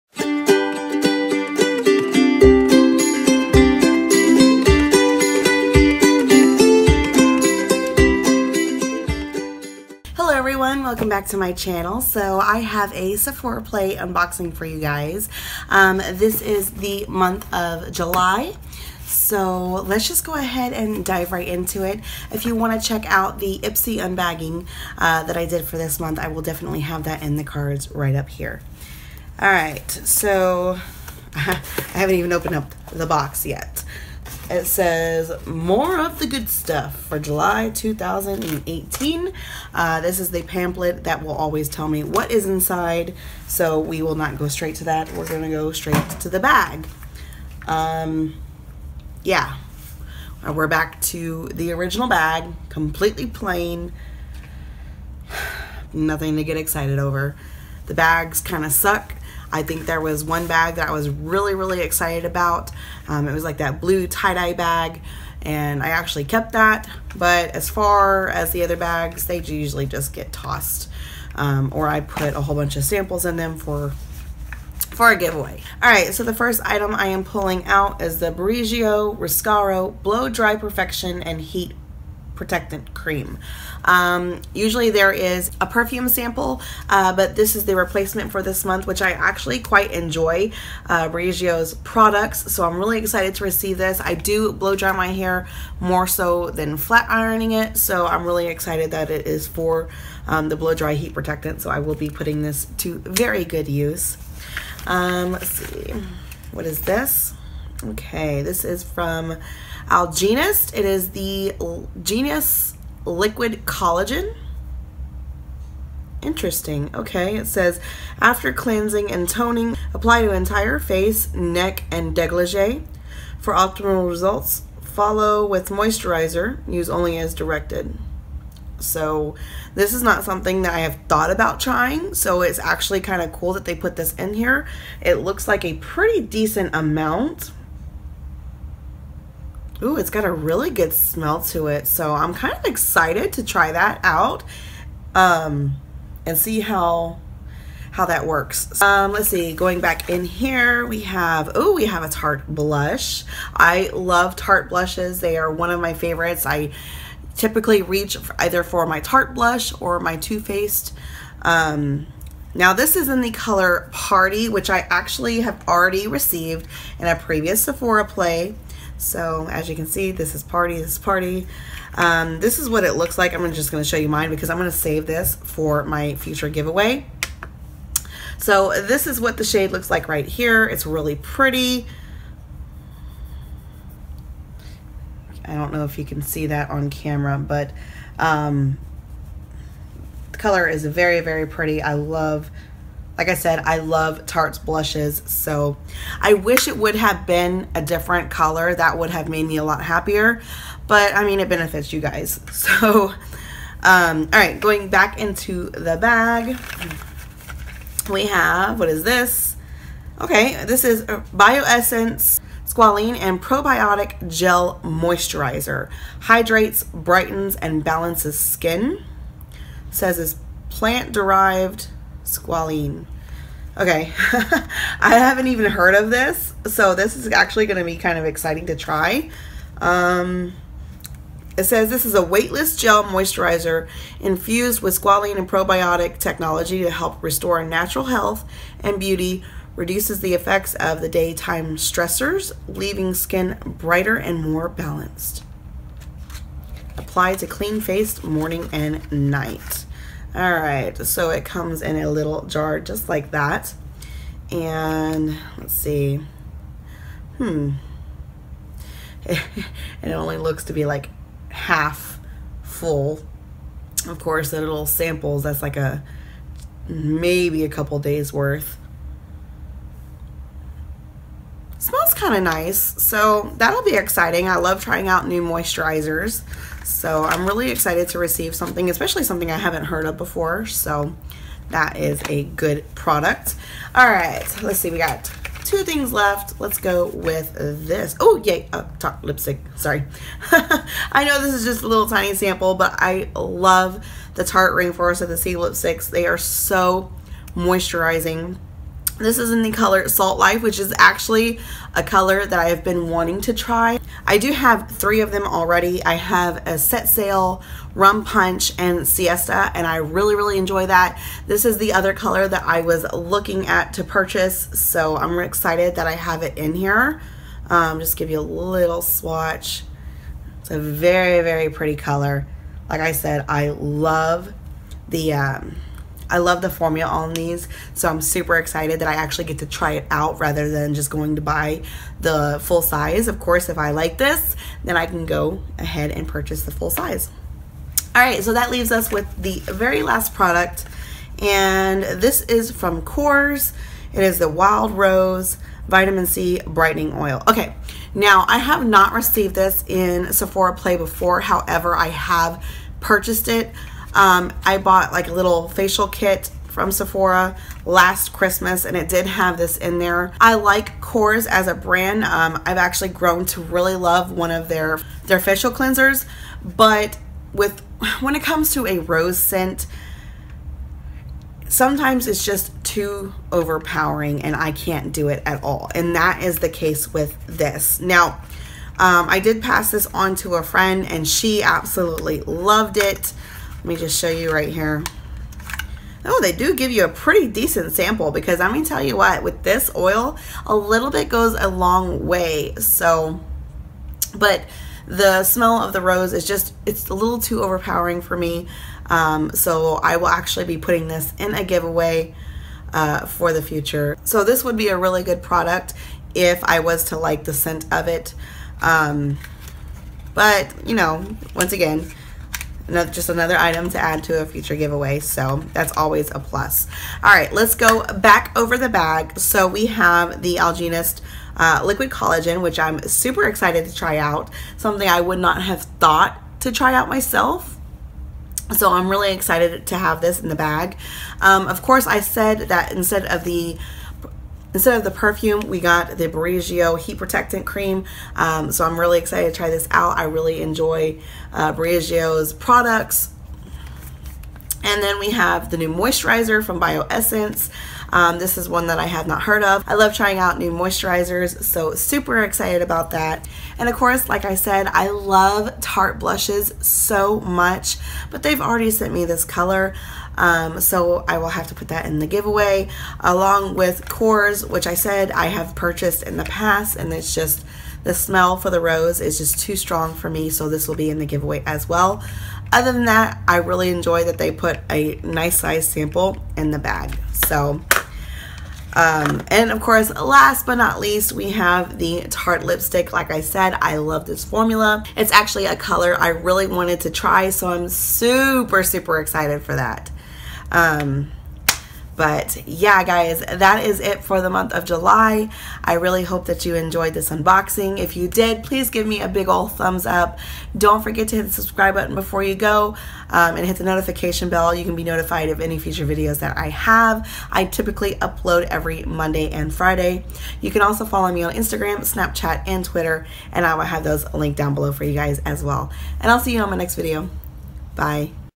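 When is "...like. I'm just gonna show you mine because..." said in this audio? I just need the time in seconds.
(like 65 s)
173 s.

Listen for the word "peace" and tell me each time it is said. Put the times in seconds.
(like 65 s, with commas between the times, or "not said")
not said.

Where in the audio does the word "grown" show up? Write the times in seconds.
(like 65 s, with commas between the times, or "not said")
363 s.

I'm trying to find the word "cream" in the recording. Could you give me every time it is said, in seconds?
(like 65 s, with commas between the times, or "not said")
82 s, 437 s.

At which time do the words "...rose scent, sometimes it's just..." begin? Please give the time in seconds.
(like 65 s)
368 s.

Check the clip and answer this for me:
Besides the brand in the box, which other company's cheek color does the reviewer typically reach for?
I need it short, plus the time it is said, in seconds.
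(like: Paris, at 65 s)
Too Faced, at 160 s.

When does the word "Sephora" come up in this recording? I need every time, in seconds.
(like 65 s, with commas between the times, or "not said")
13 s, 167 s, 350 s, 356 s.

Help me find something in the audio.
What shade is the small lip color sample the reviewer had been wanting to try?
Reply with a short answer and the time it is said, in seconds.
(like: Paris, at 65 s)
Salt Life, at 300 s.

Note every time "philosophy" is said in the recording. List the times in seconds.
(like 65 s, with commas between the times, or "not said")
not said.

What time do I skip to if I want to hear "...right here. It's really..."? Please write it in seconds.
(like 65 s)
180 s.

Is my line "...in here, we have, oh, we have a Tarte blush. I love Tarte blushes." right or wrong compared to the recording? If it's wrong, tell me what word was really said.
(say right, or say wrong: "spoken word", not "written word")
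right.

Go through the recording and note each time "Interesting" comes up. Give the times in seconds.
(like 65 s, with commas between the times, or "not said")
116 s.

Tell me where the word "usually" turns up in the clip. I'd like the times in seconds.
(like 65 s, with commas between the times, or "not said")
69 s, 84 s.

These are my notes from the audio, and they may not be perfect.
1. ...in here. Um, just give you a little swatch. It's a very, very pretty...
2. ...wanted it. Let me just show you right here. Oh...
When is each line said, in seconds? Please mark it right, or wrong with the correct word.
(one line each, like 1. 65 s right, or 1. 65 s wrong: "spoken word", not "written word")
1. 316 s right
2. 382 s wrong: "loved", not "wanted".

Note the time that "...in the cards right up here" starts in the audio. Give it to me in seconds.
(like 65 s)
27 s.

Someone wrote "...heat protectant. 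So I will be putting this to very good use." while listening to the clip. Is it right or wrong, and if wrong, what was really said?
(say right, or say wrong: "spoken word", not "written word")
right.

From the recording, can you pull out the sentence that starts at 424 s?
Something I would not have thought to try out myself.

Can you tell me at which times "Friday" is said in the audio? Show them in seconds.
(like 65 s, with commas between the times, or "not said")
509 s.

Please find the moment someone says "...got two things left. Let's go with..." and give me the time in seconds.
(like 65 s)
284 s.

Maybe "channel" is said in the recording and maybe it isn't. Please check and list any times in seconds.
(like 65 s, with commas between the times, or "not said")
11 s.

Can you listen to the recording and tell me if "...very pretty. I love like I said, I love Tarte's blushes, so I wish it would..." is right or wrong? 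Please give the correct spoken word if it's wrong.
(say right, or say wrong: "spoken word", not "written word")
right.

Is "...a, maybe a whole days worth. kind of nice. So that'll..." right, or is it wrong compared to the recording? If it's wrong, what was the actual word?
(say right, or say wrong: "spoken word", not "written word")
wrong: "couple", not "whole".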